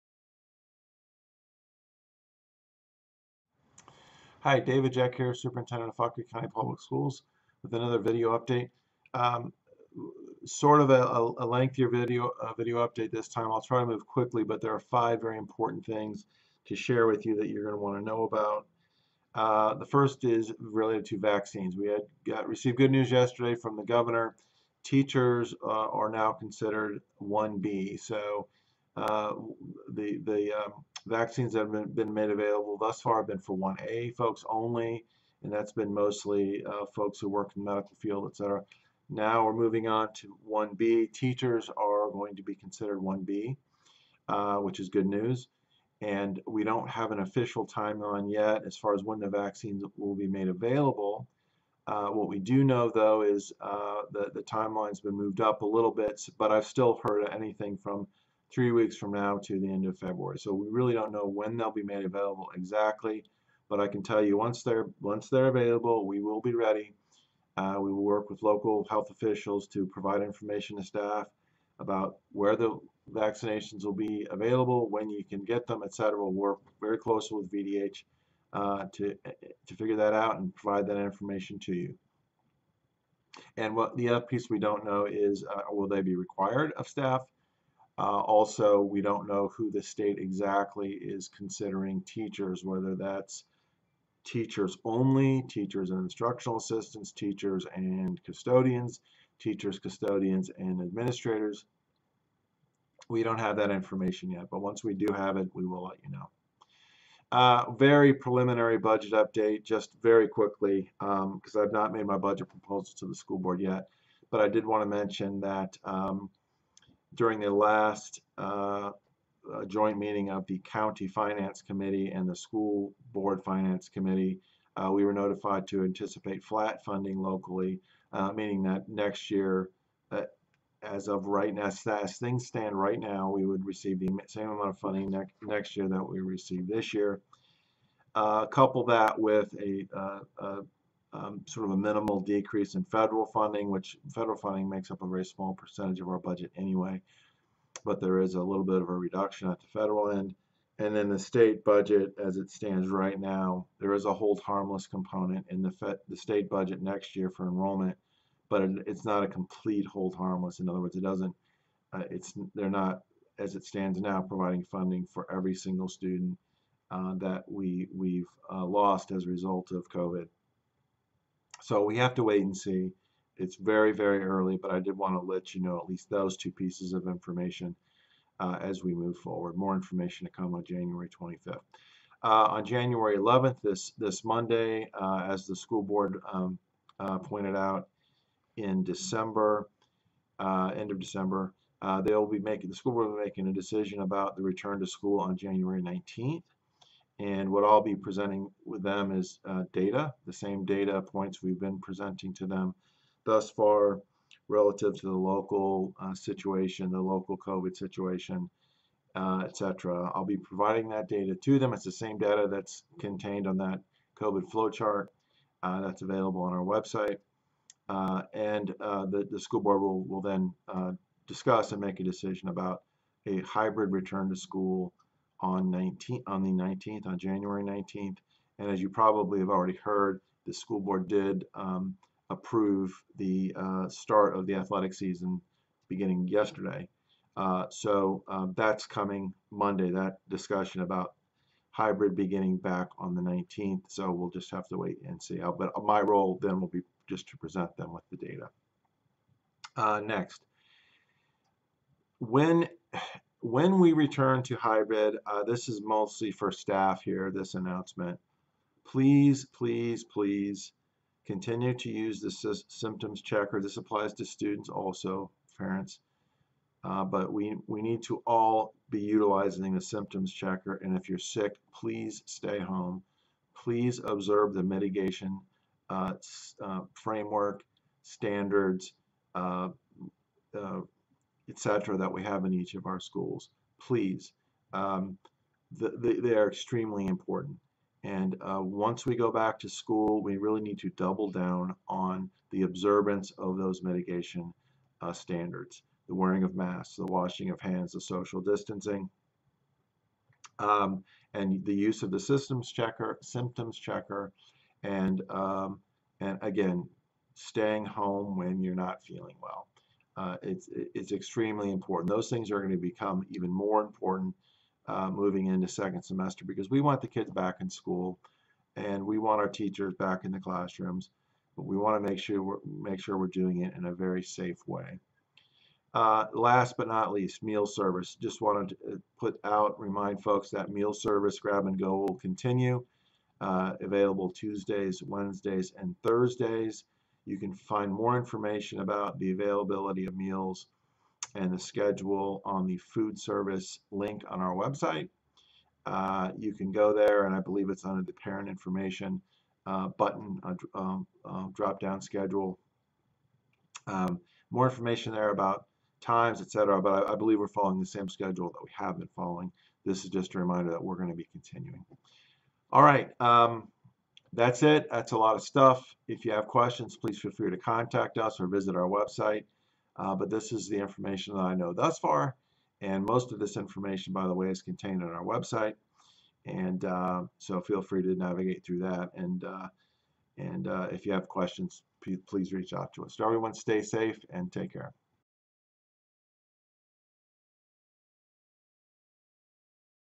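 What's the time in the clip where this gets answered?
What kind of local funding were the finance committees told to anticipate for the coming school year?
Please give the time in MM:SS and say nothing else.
02:06.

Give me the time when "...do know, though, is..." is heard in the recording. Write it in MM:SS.
00:52.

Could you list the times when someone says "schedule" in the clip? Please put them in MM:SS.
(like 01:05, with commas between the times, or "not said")
05:41, 05:52, 05:58.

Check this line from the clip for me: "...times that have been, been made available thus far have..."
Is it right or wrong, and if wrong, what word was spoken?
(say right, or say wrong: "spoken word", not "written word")
wrong: "vaccines", not "times".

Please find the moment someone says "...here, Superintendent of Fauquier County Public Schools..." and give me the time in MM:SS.
00:05.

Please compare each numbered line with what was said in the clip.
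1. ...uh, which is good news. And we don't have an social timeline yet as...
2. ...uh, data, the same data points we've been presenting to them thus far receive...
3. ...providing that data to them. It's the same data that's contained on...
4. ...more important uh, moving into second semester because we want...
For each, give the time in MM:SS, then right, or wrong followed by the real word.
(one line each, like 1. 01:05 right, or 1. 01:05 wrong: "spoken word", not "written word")
1. 00:44 wrong: "official", not "social"
2. 03:19 wrong: "relative", not "receive"
3. 03:30 right
4. 05:13 right.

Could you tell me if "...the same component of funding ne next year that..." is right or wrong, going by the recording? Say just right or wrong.
wrong.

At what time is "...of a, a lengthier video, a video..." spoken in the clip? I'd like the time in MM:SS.
00:10.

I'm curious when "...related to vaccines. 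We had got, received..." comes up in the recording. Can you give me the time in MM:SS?
00:20.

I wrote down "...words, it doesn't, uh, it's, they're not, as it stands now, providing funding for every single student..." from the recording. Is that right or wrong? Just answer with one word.
right.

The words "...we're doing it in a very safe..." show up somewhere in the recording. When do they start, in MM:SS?
05:23.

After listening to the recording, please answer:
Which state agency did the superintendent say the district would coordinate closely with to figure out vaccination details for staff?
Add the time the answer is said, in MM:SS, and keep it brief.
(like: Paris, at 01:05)
VDH, at 01:17.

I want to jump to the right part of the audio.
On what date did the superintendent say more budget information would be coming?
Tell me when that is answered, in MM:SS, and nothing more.
03:00.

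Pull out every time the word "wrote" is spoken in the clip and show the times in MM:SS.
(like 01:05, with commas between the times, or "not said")
not said.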